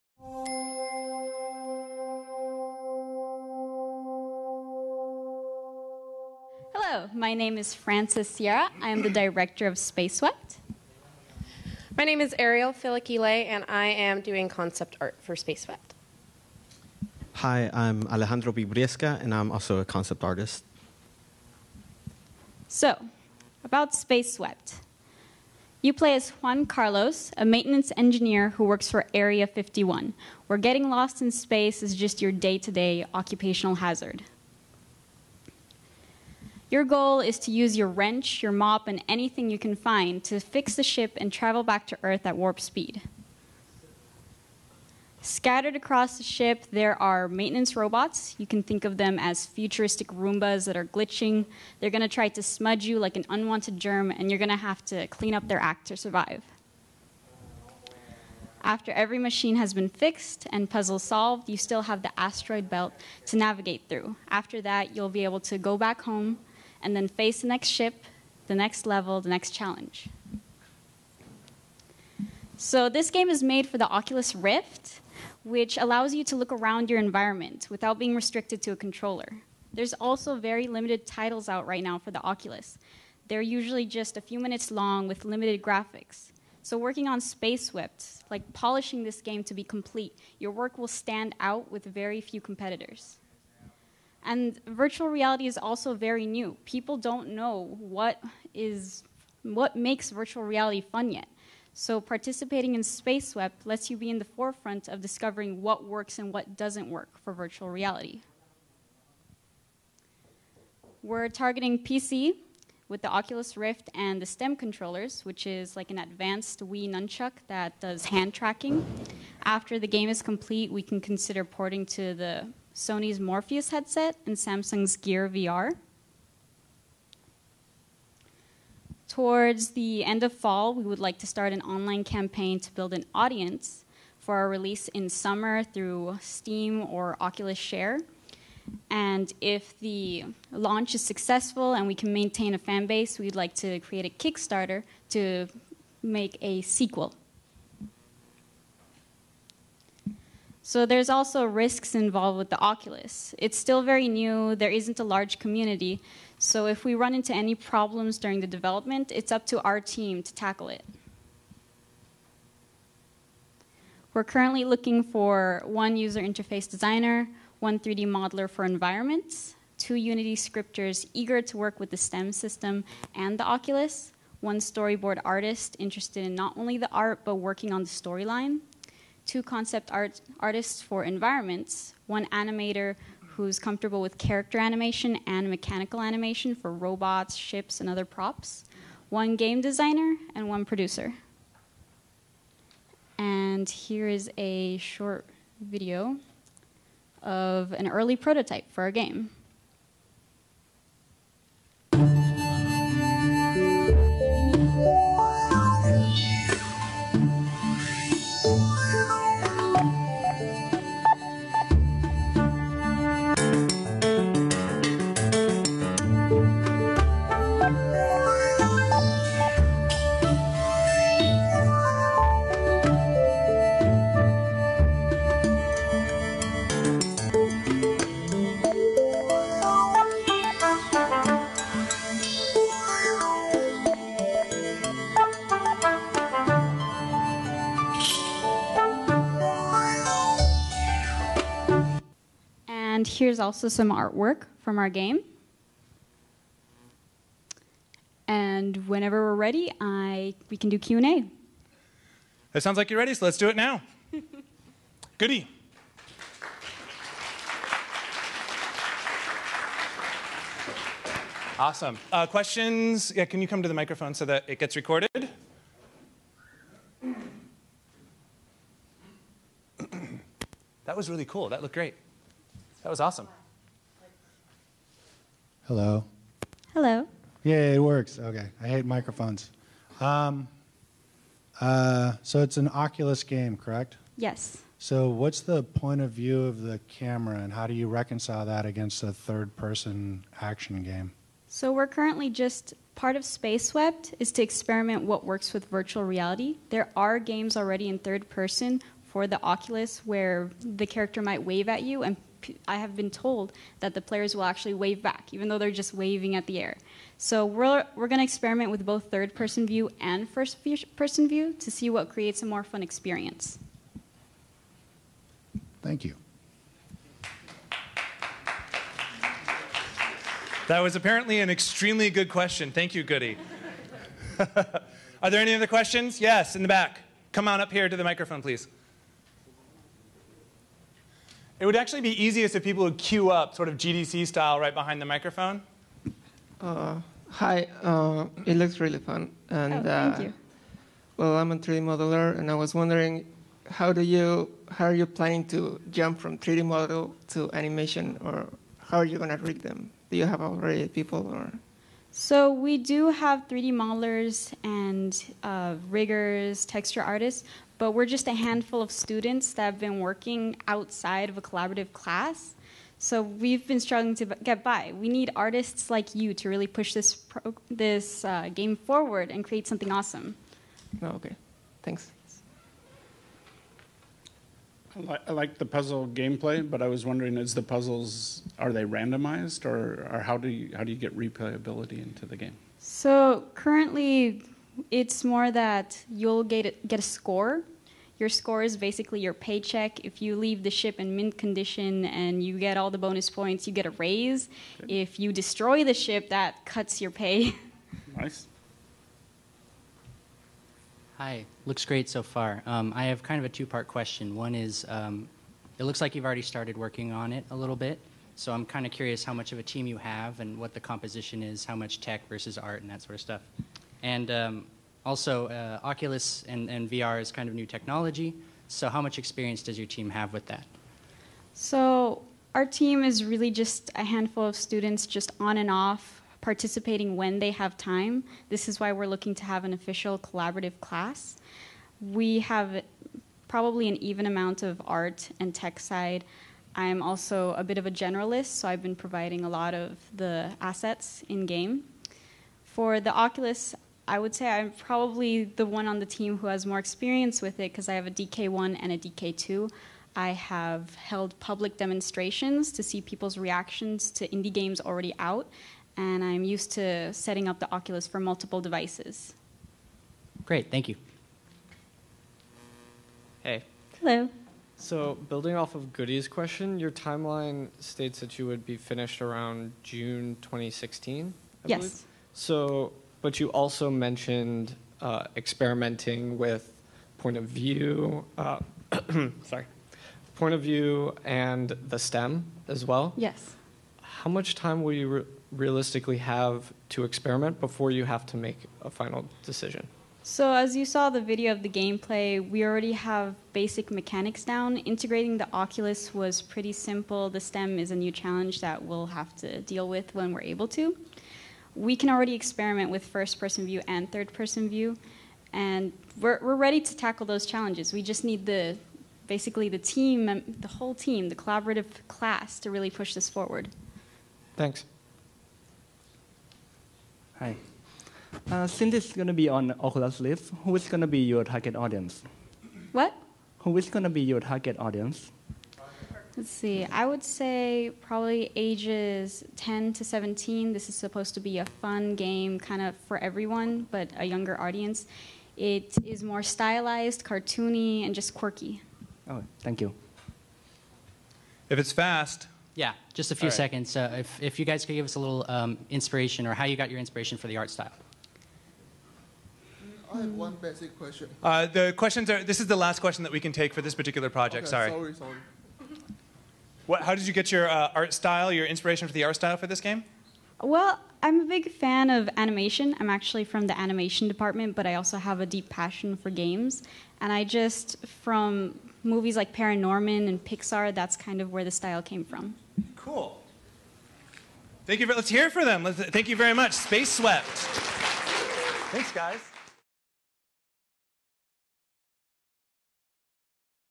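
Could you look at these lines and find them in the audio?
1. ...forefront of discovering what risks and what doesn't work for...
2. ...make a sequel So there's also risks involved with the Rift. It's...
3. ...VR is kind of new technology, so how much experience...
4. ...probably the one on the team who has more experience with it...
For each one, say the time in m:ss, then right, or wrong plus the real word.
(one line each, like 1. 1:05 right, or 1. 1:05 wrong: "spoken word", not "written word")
1. 1:44 wrong: "works", not "risks"
2. 2:26 wrong: "Oculus", not "Rift"
3. 6:56 right
4. 7:24 right.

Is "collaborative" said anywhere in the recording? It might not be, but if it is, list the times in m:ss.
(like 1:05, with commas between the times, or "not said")
6:01, 7:10, 8:31.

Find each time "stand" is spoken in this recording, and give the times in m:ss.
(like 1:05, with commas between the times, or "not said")
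1:30.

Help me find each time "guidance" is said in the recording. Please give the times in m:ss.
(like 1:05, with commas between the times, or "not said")
not said.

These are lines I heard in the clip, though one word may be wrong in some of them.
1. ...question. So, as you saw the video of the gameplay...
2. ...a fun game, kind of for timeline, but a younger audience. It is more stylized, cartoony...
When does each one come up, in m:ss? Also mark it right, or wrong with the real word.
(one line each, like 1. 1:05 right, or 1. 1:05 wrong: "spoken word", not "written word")
1. 8:09 wrong: "decision", not "question"
2. 8:51 wrong: "everyone", not "timeline".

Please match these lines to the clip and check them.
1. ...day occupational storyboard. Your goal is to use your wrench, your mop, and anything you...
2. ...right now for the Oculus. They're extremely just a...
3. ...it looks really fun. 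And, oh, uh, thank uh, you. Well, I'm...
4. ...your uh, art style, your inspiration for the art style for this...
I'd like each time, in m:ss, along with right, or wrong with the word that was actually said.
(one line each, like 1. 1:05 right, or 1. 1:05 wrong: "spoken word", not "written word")
1. 0:32 wrong: "hazard", not "storyboard"
2. 1:21 wrong: "usually", not "extremely"
3. 5:38 right
4. 9:17 right.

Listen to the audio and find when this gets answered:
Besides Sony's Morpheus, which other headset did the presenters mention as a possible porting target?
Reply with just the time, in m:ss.
2:04.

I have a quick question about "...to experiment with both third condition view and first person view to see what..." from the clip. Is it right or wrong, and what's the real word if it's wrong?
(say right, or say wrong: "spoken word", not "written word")
wrong: "person", not "condition".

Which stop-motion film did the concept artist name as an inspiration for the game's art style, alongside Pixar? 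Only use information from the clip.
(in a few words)
Paranorman.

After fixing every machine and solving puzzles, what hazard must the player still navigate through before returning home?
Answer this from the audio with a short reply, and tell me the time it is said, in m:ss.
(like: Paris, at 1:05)
the asteroid belt, at 1:02.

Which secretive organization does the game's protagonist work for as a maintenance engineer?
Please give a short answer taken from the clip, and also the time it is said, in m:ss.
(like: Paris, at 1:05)
Area 51, at 0:29.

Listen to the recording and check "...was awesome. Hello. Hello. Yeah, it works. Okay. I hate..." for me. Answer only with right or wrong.
right.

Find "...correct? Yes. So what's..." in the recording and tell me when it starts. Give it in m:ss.
4:43.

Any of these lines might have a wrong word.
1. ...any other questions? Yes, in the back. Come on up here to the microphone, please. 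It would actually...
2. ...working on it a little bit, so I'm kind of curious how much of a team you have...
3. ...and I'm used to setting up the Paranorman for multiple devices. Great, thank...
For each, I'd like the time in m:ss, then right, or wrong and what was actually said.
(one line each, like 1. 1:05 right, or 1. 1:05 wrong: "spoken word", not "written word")
1. 5:25 right
2. 6:46 right
3. 7:35 wrong: "Oculus", not "Paranorman".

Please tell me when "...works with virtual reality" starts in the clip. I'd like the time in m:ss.
4:55.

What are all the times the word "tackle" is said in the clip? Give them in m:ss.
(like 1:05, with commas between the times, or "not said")
2:40, 8:26.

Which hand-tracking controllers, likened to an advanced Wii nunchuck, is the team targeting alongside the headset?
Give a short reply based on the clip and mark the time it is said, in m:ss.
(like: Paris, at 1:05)
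STEM controllers, at 1:54.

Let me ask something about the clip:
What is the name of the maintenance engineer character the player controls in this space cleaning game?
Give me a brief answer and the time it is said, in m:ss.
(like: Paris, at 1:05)
Juan Carlos, at 0:26.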